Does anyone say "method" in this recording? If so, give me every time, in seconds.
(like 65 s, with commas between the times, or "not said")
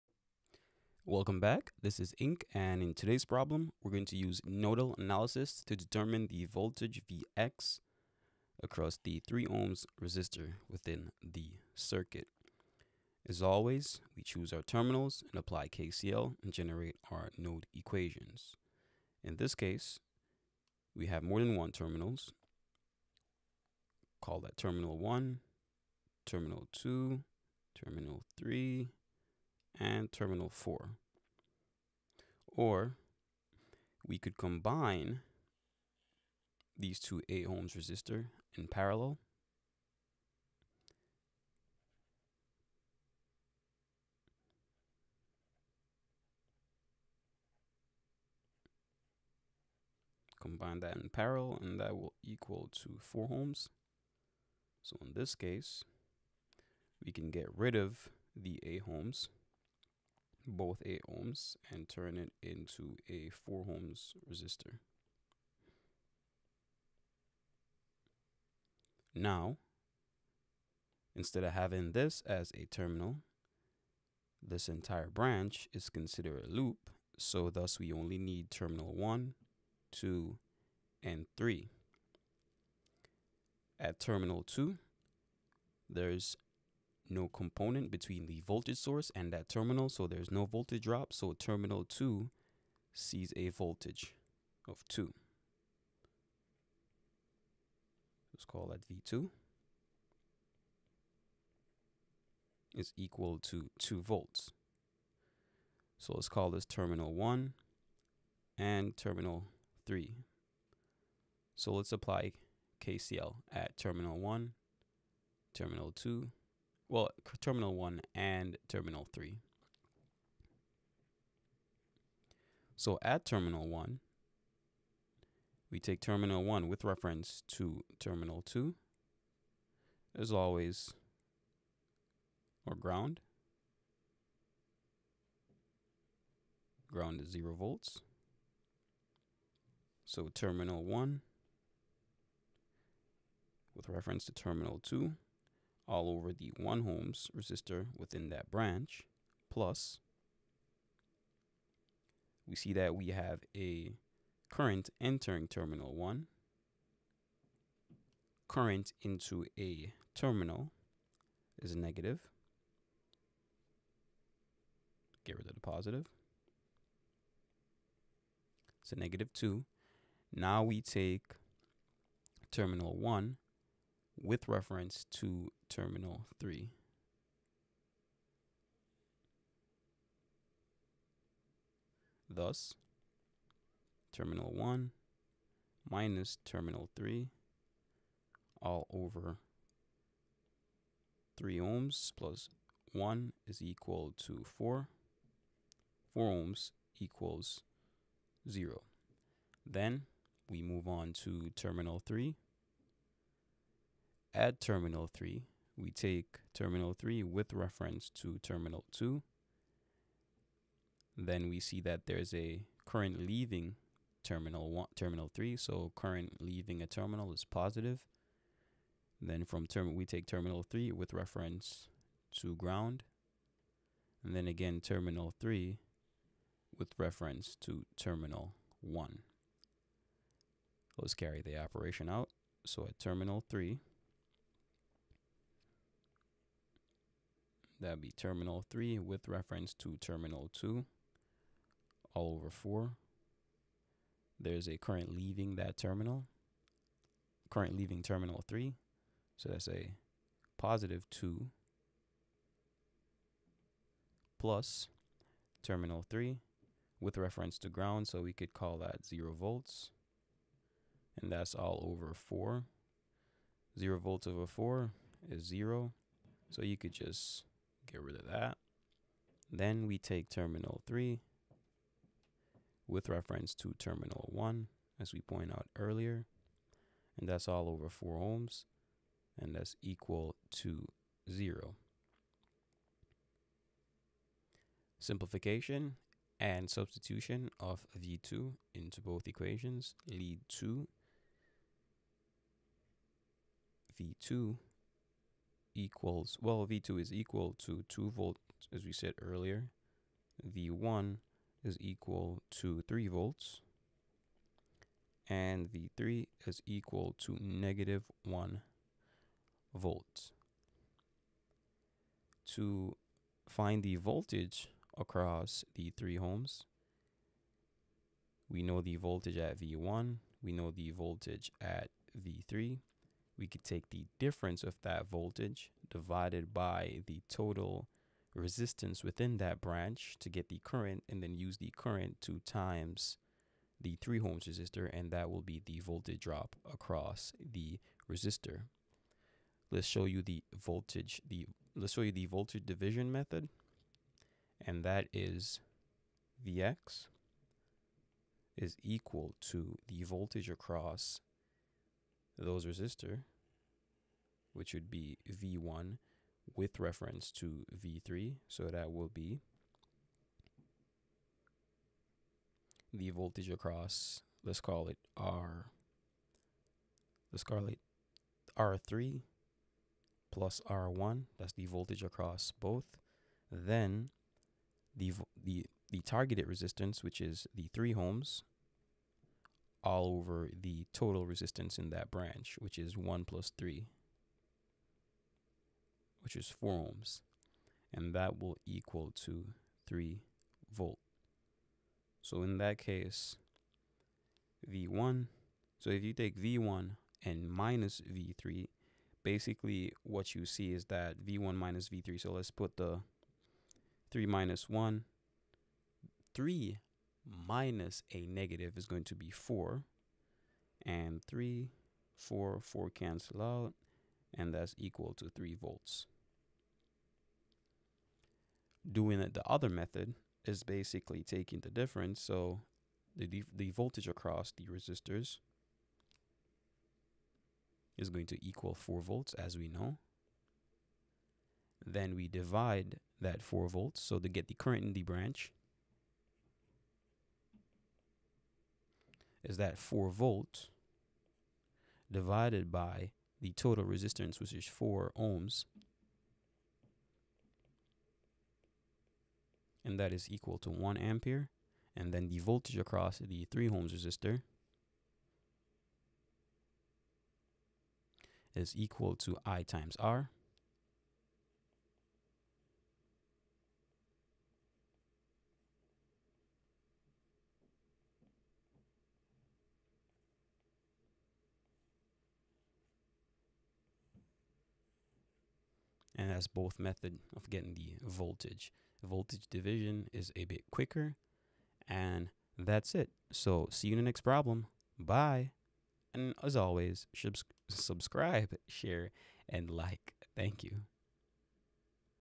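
343 s, 419 s, 476 s.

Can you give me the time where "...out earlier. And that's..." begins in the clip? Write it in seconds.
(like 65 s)
275 s.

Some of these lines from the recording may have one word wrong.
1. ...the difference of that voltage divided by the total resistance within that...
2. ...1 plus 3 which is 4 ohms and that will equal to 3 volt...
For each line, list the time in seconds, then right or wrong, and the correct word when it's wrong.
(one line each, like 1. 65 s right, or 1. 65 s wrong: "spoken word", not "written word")
1. 323 s right
2. 382 s right.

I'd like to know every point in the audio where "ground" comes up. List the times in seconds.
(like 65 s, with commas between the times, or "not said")
132 s, 136 s, 222 s, 257 s.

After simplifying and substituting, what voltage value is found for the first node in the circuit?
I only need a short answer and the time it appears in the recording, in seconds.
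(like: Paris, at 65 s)
3 volts, at 300 s.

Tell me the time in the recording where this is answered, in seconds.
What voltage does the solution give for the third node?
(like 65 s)
305 s.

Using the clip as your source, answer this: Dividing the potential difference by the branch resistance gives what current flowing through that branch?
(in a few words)
1 ampere.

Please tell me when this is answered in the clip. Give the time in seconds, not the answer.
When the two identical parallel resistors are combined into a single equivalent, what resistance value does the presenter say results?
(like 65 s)
51 s.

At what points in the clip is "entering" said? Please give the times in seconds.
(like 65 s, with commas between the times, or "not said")
155 s.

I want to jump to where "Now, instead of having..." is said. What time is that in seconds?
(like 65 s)
69 s.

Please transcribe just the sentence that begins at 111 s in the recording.
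So let's apply KCL at terminal 1, terminal 2, well, terminal one and terminal three.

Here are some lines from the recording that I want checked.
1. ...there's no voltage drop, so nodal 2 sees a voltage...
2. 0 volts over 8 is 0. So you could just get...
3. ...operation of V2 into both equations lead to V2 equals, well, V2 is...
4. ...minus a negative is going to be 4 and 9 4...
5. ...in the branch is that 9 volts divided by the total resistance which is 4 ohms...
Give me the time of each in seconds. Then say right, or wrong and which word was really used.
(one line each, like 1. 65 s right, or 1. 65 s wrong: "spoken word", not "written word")
1. 90 s wrong: "terminal", not "nodal"
2. 263 s wrong: "4", not "8"
3. 286 s wrong: "substitution", not "operation"
4. 407 s wrong: "3", not "9"
5. 434 s wrong: "4", not "9".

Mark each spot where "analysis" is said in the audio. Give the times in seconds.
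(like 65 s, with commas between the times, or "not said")
4 s.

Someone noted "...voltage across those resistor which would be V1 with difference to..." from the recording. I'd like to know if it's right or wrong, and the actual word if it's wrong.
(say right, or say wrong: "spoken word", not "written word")
wrong: "reference", not "difference".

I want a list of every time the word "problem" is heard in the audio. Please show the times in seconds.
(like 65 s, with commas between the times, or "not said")
3 s, 484 s.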